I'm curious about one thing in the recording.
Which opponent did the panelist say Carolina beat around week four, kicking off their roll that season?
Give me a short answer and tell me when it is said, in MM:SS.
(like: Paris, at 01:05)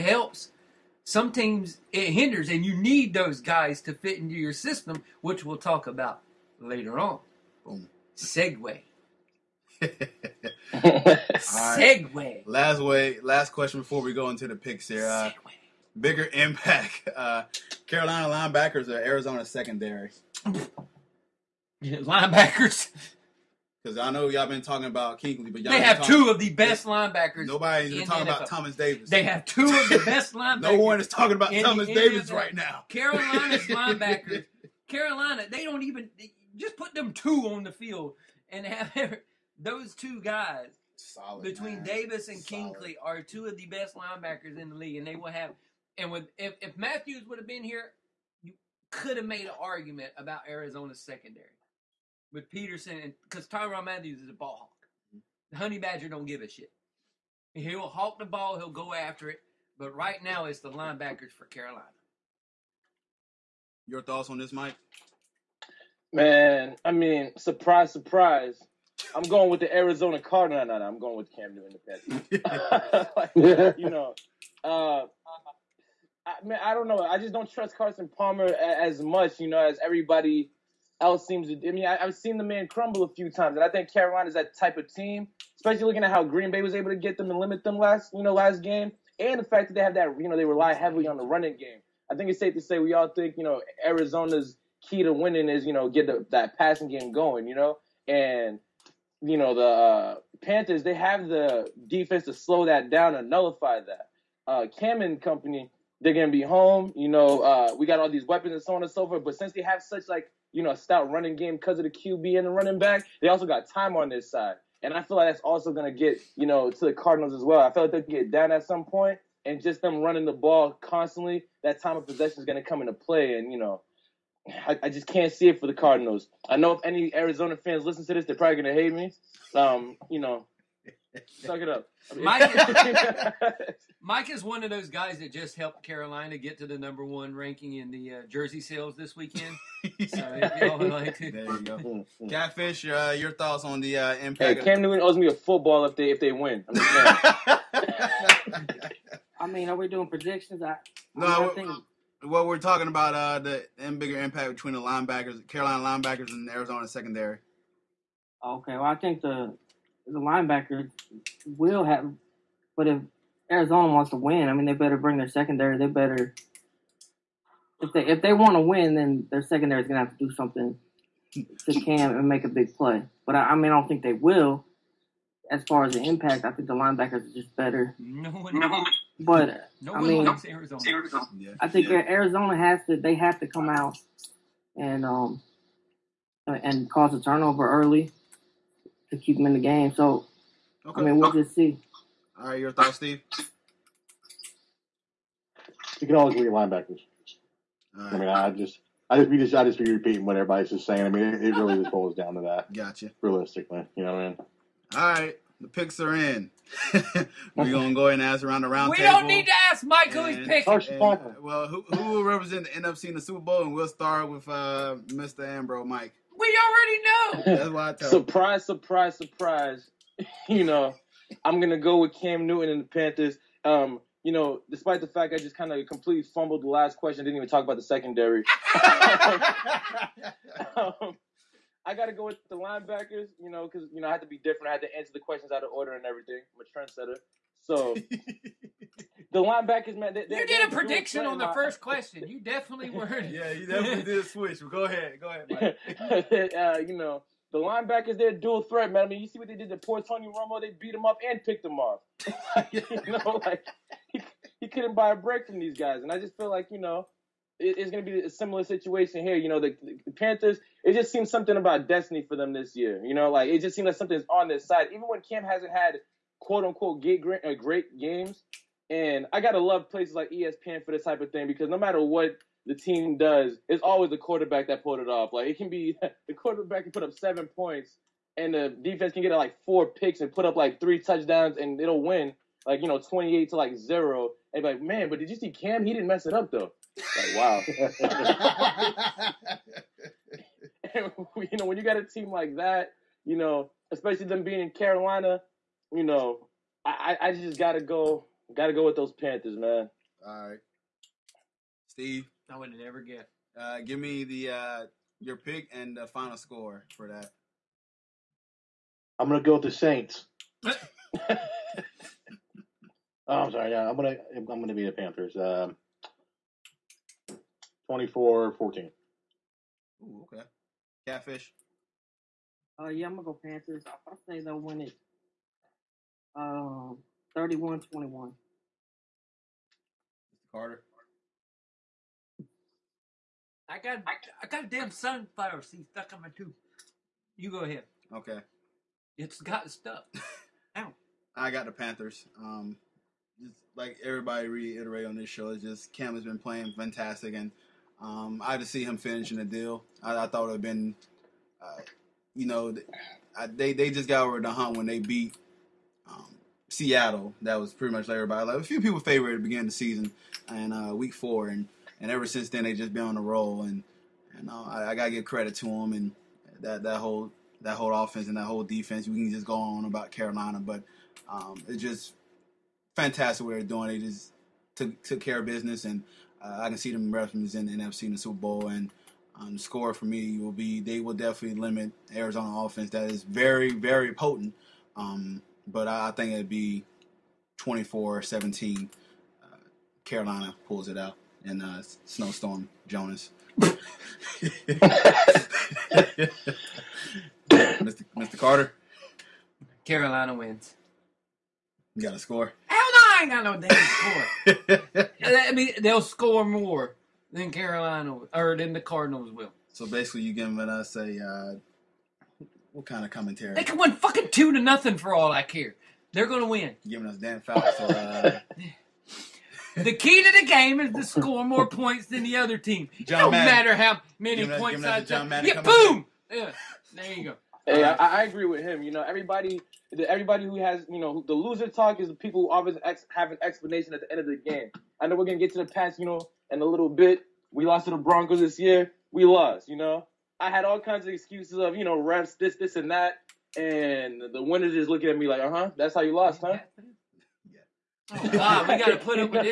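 Seattle, at 05:56.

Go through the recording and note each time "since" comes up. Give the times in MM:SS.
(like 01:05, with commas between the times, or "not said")
01:49, 06:02.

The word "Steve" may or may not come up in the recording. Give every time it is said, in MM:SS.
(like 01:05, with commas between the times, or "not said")
03:12, 05:01.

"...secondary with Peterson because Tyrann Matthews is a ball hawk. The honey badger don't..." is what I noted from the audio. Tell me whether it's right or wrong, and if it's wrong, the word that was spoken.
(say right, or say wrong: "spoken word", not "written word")
right.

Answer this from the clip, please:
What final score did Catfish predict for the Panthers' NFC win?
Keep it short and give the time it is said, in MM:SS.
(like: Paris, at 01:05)
31-21, at 05:27.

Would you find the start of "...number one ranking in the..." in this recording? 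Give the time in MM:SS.
02:16.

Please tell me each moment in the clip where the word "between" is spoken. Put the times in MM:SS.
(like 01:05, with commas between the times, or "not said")
00:41, 02:34.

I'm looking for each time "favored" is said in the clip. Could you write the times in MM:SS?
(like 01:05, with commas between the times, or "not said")
05:58.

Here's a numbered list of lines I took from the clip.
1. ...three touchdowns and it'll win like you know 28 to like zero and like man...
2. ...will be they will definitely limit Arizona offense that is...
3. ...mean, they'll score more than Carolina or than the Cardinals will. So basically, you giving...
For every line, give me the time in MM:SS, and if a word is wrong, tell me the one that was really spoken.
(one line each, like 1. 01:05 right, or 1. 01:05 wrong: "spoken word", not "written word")
1. 04:40 right
2. 06:20 right
3. 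06:45 right.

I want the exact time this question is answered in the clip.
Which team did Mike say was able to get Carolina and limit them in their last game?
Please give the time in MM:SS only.
01:26.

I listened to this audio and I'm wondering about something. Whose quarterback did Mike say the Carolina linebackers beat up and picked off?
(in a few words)
Tony Romo.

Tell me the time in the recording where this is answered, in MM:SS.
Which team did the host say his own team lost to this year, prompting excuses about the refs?
07:17.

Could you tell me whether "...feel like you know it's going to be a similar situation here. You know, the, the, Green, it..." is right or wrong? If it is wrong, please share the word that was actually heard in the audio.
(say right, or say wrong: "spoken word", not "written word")
wrong: "Panthers", not "Green".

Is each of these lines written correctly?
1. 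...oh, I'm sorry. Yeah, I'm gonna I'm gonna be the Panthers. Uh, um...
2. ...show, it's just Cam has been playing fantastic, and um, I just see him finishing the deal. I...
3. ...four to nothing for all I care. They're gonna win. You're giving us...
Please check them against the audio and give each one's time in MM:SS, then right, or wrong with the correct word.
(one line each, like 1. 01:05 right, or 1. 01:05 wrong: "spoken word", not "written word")
1. 05:10 right
2. 05:45 right
3. 06:54 wrong: "two", not "four".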